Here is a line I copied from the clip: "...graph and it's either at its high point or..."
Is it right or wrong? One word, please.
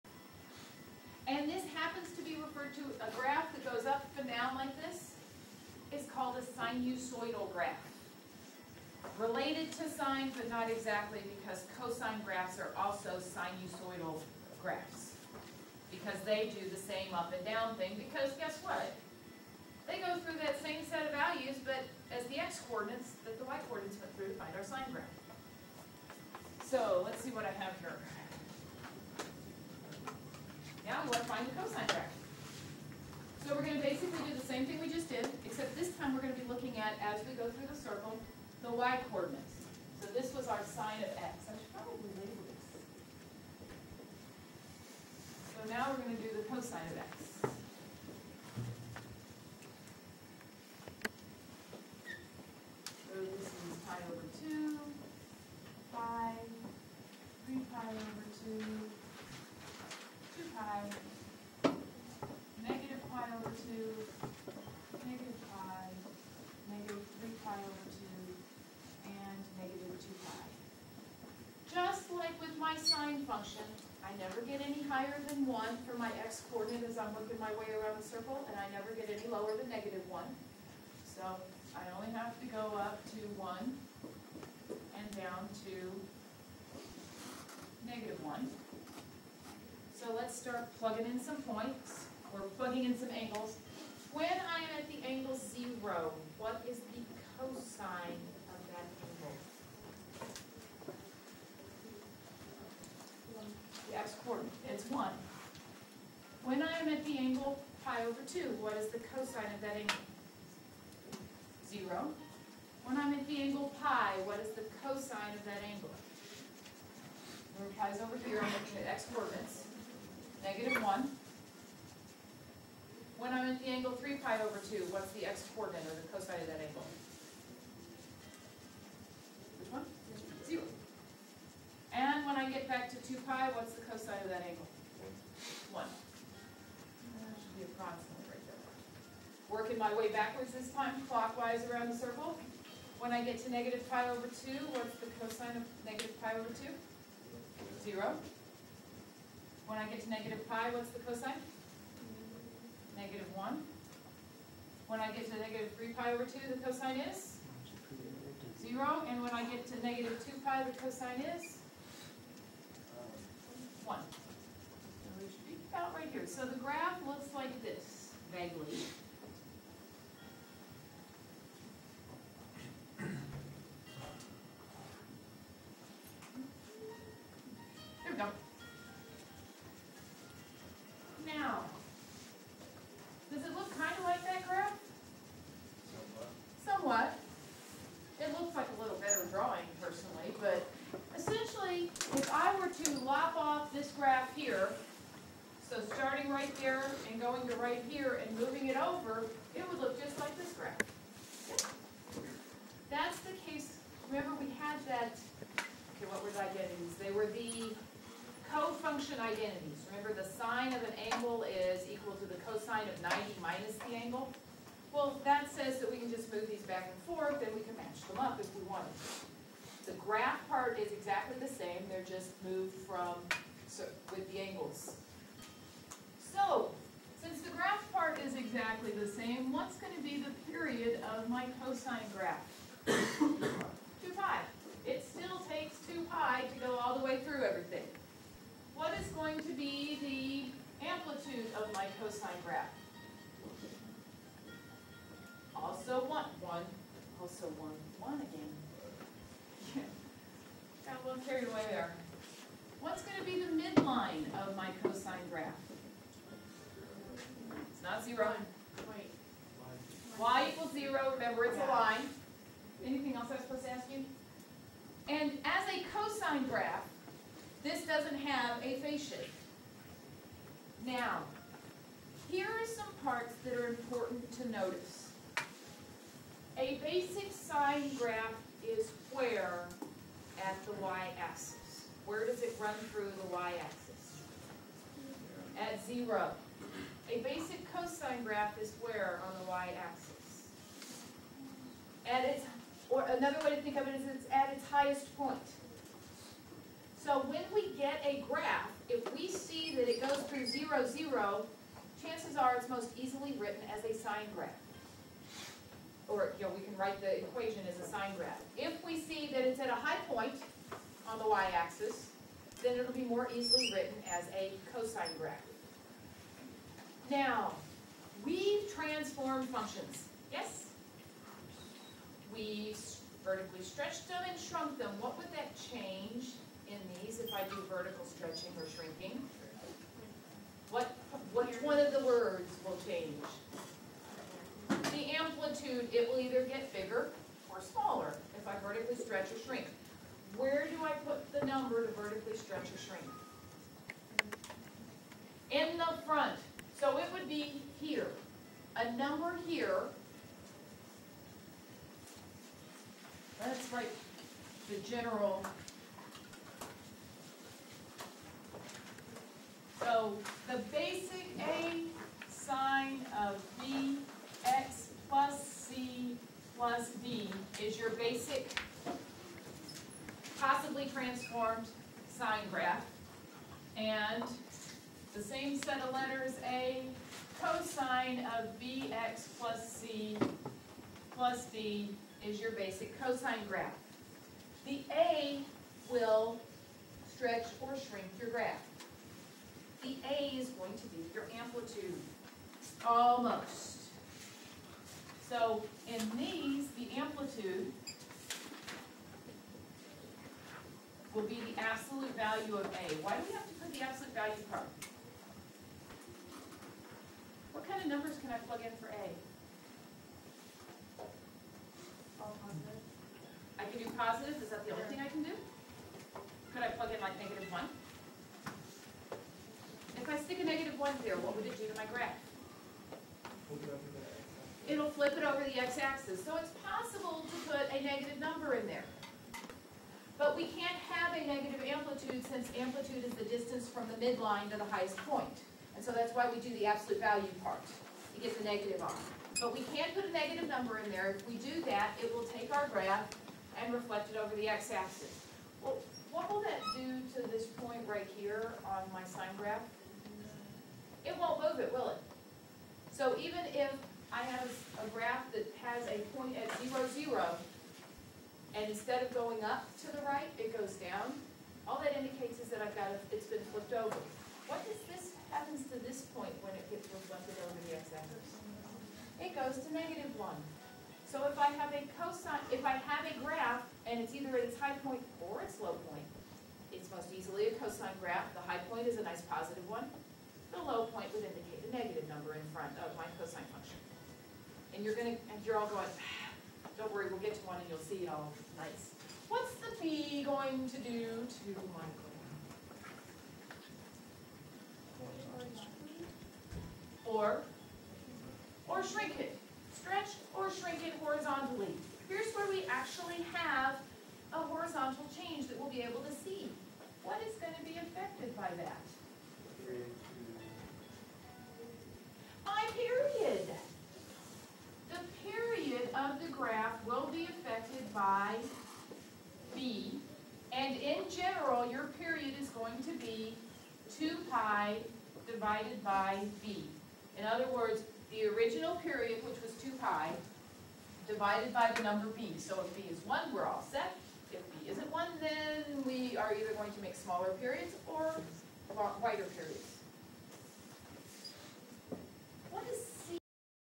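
right.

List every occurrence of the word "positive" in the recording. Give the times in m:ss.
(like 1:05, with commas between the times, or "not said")
6:53, 7:59.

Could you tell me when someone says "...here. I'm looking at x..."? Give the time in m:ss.
1:58.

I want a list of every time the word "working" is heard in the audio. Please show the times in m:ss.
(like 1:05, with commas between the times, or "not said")
1:17, 2:19.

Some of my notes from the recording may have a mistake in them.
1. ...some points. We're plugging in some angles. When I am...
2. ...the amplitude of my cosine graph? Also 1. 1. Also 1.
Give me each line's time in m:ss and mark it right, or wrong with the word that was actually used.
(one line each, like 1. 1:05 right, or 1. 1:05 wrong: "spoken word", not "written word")
1. 1:31 right
2. 4:00 right.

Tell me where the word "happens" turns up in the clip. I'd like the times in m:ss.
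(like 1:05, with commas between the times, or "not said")
7:45.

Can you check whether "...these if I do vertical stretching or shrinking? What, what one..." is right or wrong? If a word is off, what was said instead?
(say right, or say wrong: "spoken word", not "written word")
right.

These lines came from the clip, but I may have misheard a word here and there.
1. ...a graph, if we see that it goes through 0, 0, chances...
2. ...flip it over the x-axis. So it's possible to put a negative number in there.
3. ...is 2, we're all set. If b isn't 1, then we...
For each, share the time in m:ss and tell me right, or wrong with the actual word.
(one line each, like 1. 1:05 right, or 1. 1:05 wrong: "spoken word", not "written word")
1. 4:58 right
2. 7:04 right
3. 8:52 wrong: "1", not "2".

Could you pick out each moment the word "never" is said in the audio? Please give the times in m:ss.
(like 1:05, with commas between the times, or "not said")
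1:14, 1:18.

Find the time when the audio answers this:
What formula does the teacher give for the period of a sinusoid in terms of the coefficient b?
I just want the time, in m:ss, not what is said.
8:44.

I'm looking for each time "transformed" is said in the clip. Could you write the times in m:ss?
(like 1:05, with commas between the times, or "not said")
5:18, 6:10.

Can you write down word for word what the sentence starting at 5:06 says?
Or you know, we can write the equation as a sine graph.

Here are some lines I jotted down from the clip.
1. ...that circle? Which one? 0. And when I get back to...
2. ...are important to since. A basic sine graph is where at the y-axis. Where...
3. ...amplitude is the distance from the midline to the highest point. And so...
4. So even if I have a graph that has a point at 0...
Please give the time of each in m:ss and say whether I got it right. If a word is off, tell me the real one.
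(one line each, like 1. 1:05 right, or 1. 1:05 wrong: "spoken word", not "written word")
1. 2:06 wrong: "angle", not "circle"
2. 4:33 wrong: "notice", not "since"
3. 7:12 right
4. 7:32 right.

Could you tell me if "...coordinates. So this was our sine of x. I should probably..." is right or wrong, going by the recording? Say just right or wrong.
right.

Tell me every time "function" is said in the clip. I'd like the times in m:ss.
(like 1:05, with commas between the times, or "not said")
1:13, 3:28, 5:19, 8:03.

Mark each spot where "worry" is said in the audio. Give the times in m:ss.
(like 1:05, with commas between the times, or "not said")
8:06.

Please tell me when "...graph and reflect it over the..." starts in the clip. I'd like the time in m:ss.
7:22.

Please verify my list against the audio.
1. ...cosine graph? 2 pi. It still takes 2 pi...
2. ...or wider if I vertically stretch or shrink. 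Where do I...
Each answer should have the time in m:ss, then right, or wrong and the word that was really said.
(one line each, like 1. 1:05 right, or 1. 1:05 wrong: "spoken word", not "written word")
1. 3:51 right
2. 5:37 wrong: "smaller", not "wider".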